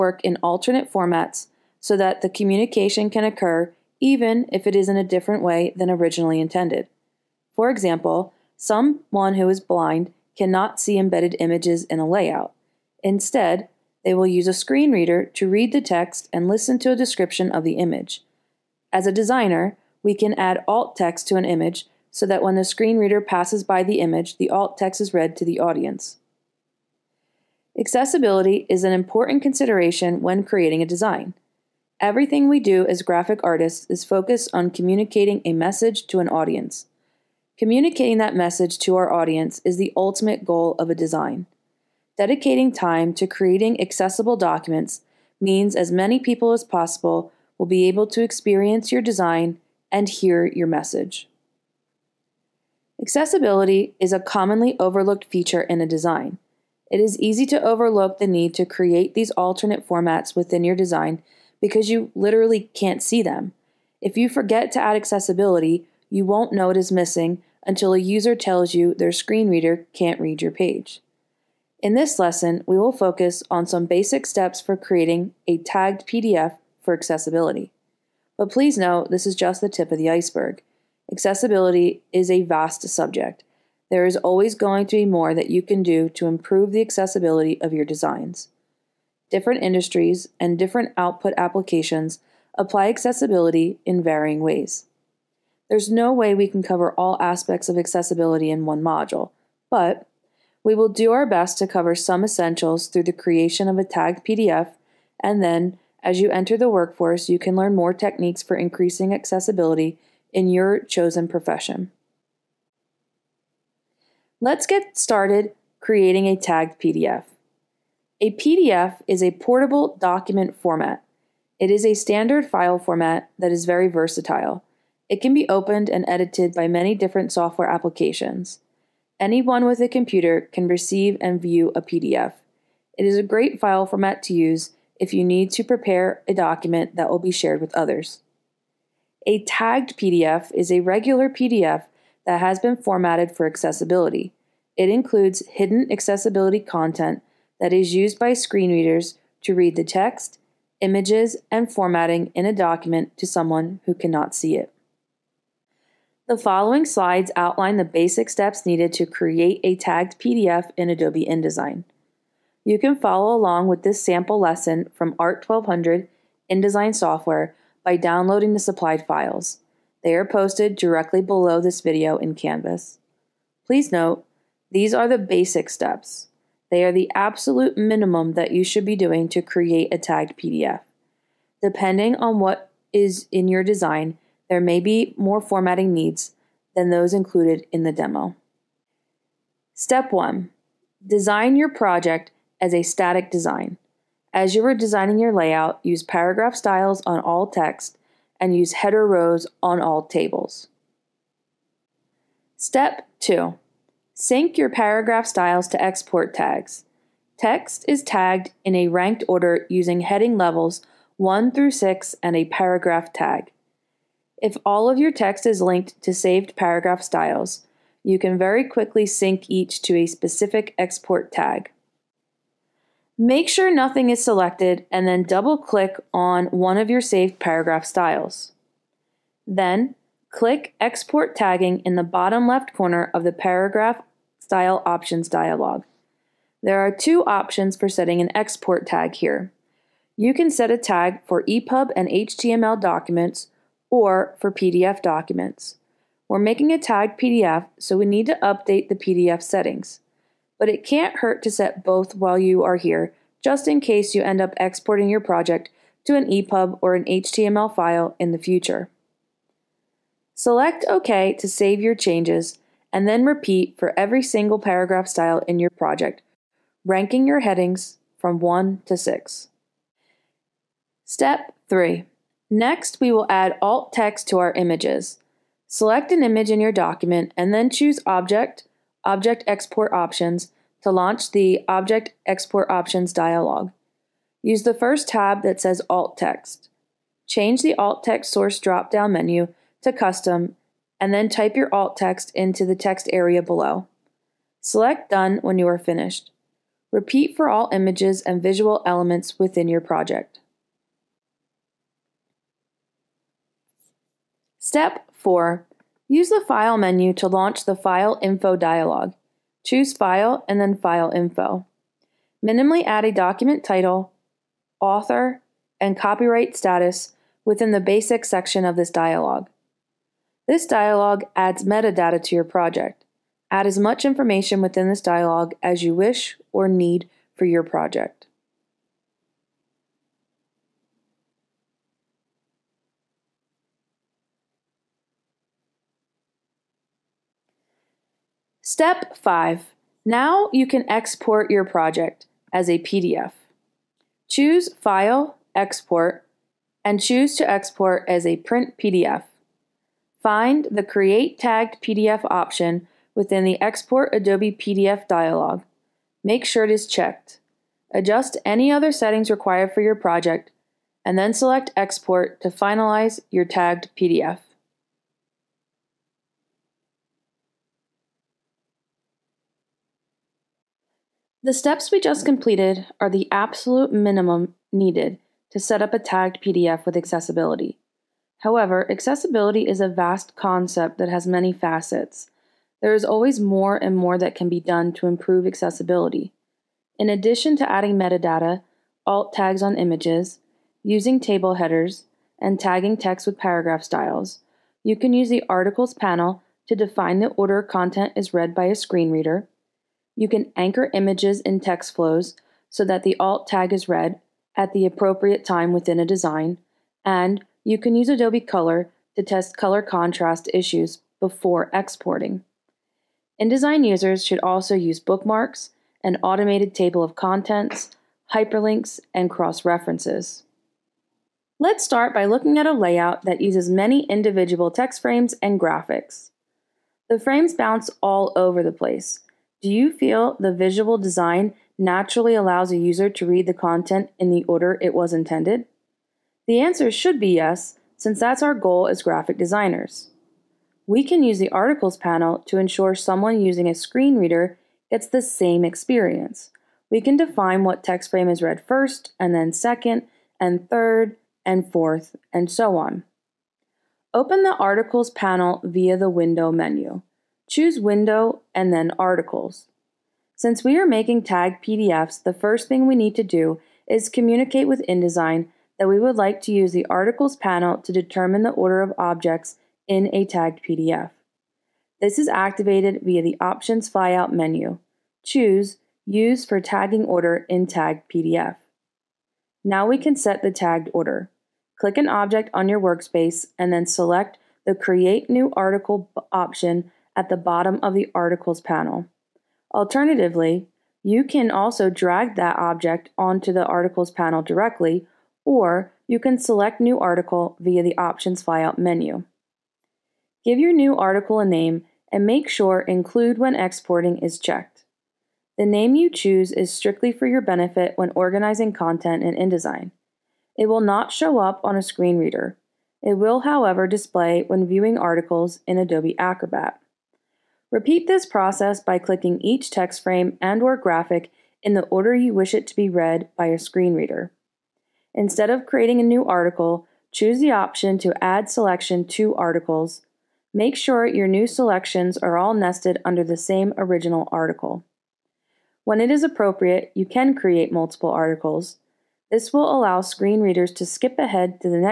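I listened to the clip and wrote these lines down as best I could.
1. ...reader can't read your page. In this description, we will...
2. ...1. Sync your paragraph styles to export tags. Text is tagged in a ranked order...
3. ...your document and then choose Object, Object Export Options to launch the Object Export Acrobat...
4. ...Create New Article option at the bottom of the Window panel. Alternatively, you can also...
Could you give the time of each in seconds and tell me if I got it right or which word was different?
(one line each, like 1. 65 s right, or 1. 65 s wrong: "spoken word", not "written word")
1. 69 s wrong: "lesson", not "description"
2. 203 s wrong: "2", not "1"
3. 276 s wrong: "Options", not "Acrobat"
4. 484 s wrong: "Articles", not "Window".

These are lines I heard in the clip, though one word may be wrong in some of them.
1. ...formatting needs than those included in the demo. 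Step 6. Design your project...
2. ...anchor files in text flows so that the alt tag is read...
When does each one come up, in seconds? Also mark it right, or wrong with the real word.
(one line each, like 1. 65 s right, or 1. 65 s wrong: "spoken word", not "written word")
1. 185 s wrong: "1", not "6"
2. 400 s wrong: "images", not "files".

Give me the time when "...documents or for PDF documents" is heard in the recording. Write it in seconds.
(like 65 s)
242 s.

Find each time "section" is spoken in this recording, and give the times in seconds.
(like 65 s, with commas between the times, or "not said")
318 s.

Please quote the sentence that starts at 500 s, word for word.
Give your new article a name and make sure Include when exporting is checked.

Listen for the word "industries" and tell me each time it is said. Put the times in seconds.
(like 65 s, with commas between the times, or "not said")
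89 s.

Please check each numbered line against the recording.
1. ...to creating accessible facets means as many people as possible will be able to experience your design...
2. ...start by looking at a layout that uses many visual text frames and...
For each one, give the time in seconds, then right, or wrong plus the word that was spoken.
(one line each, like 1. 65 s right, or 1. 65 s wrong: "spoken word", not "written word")
1. 43 s wrong: "documents", not "facets"
2. 421 s wrong: "individual", not "visual".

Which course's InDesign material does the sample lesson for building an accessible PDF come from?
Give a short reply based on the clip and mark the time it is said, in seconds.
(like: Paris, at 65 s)
ART 1200, at 165 s.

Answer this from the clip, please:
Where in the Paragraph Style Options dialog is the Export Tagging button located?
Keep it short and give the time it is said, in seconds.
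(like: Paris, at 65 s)
bottom left corner, at 232 s.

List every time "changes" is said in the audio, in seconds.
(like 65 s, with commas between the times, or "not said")
261 s, 287 s.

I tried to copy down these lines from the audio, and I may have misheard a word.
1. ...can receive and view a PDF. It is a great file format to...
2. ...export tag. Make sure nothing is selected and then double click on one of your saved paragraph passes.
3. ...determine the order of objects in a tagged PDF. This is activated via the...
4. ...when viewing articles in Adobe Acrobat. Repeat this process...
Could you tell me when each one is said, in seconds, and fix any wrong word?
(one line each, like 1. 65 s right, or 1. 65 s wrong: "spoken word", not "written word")
1. 130 s right
2. 220 s wrong: "styles", not "passes"
3. 467 s right
4. 514 s right.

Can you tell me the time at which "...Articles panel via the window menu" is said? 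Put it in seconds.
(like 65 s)
454 s.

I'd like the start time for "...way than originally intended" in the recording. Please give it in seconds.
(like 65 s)
5 s.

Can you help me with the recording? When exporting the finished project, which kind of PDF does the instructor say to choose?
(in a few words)
print PDF.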